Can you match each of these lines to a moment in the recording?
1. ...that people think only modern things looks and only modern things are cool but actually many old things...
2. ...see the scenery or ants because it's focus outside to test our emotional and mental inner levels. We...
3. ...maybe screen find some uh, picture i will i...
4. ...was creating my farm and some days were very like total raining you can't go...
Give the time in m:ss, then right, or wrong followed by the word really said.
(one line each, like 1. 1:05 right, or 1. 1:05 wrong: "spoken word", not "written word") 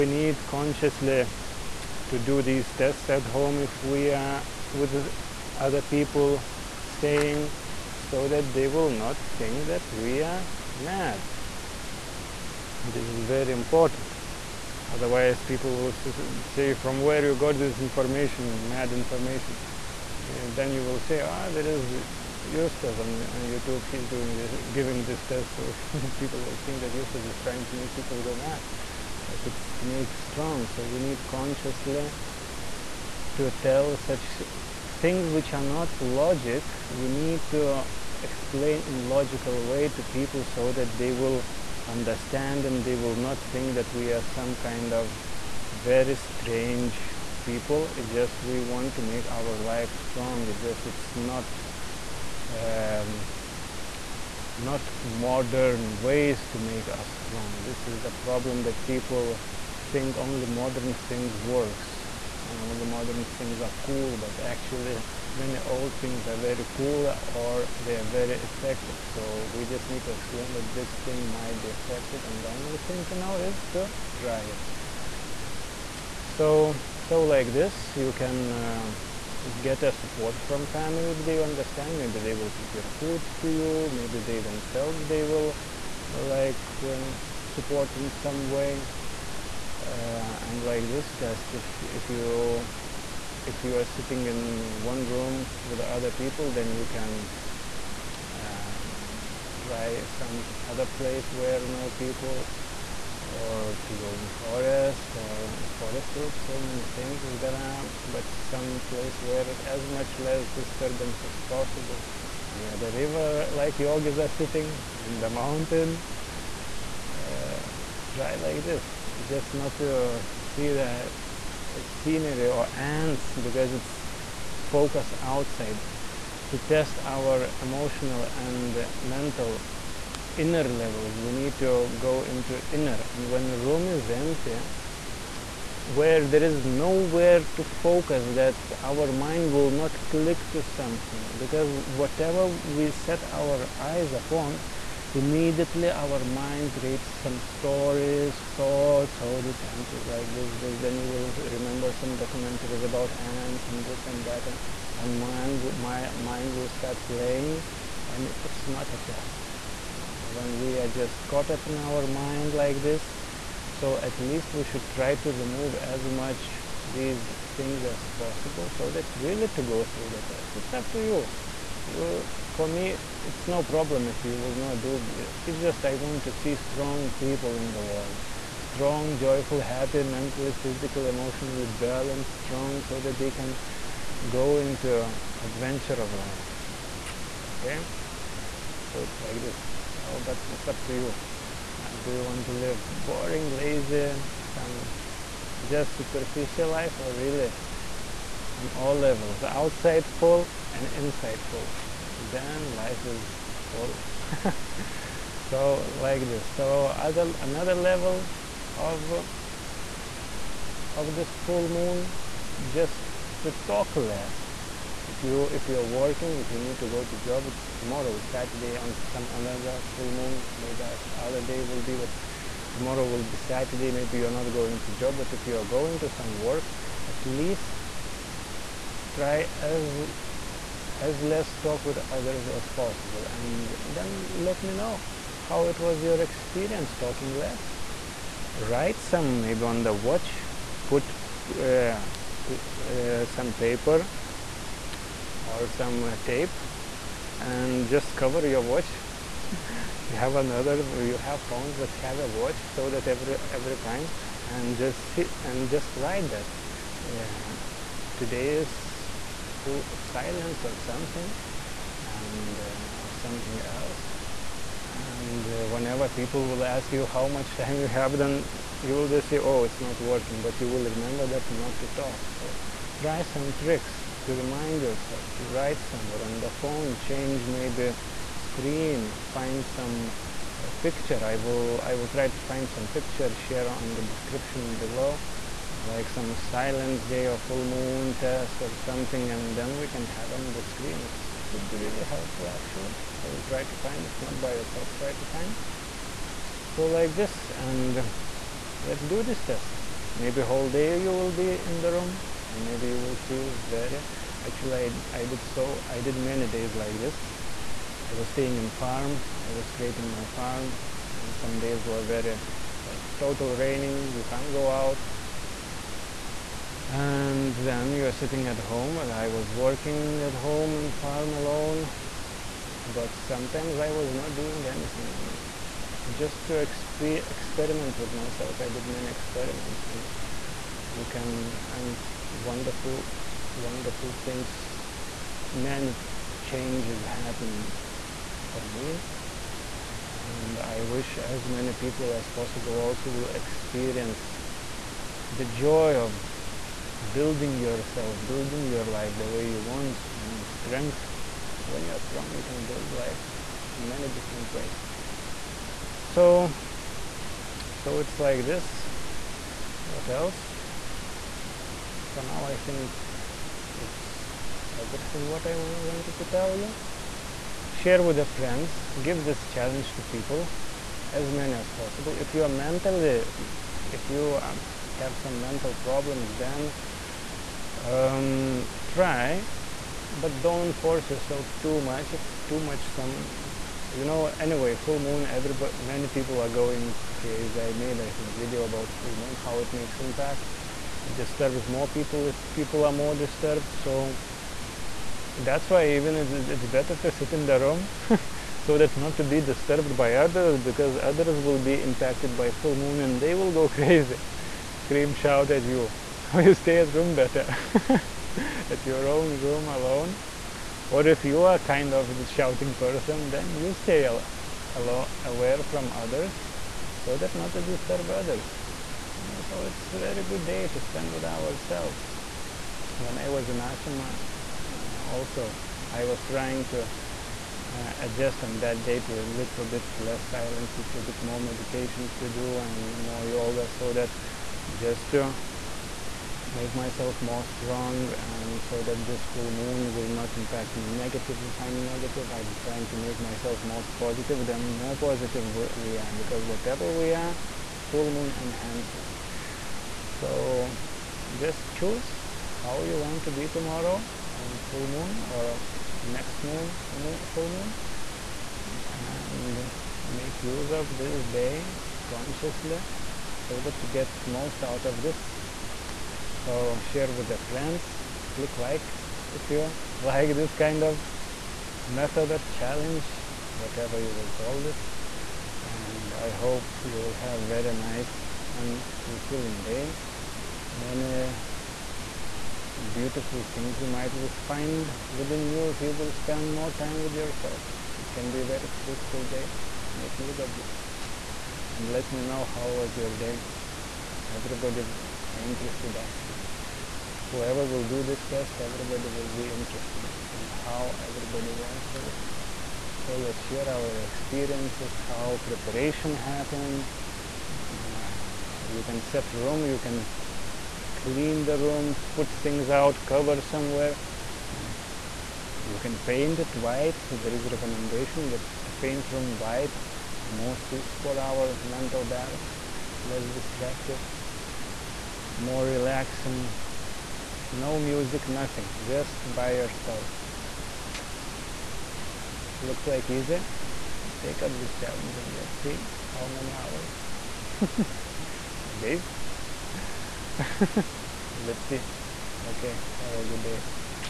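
1. 0:58 wrong: "works", not "looks"
2. 2:00 right
3. 4:37 right
4. 5:09 right.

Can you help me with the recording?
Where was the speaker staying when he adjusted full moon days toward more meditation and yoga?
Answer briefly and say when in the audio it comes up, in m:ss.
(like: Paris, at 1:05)
ashrama, at 7:03.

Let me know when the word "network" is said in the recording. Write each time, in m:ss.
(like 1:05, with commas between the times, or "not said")
not said.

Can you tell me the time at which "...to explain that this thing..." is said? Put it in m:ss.
1:10.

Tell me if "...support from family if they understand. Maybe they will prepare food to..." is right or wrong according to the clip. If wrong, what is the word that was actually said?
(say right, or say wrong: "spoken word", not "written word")
right.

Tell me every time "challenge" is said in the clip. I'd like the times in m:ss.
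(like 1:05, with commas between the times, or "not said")
6:09, 7:52, 8:54.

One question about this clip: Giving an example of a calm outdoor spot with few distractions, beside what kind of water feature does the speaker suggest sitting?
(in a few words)
river.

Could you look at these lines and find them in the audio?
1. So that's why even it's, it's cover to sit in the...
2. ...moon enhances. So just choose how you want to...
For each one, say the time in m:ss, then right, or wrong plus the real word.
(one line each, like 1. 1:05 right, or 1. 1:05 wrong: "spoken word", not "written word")
1. 6:33 wrong: "better", not "cover"
2. 7:28 right.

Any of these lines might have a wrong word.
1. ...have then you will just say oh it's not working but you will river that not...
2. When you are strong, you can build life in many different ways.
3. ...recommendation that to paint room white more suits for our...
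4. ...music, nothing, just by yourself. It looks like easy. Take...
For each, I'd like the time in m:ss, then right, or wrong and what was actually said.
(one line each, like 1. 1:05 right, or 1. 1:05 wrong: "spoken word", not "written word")
1. 4:27 wrong: "remember", not "river"
2. 5:51 right
3. 8:37 right
4. 8:47 right.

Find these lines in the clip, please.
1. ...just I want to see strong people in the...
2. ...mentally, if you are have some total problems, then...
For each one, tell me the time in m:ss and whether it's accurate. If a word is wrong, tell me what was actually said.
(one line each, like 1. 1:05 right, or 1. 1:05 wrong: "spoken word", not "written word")
1. 2:55 right
2. 6:12 wrong: "mental", not "total".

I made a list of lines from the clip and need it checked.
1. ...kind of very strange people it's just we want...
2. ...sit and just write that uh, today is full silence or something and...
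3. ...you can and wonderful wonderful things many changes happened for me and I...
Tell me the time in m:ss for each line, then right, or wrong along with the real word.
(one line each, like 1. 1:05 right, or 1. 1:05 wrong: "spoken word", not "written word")
1. 0:44 right
2. 4:15 right
3. 5:30 right.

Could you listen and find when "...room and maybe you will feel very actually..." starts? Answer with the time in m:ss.
5:01.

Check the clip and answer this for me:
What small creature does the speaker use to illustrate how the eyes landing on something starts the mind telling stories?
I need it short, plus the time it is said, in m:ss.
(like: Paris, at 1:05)
ant, at 2:29.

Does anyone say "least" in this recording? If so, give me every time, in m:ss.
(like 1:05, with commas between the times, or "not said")
2:44, 3:47.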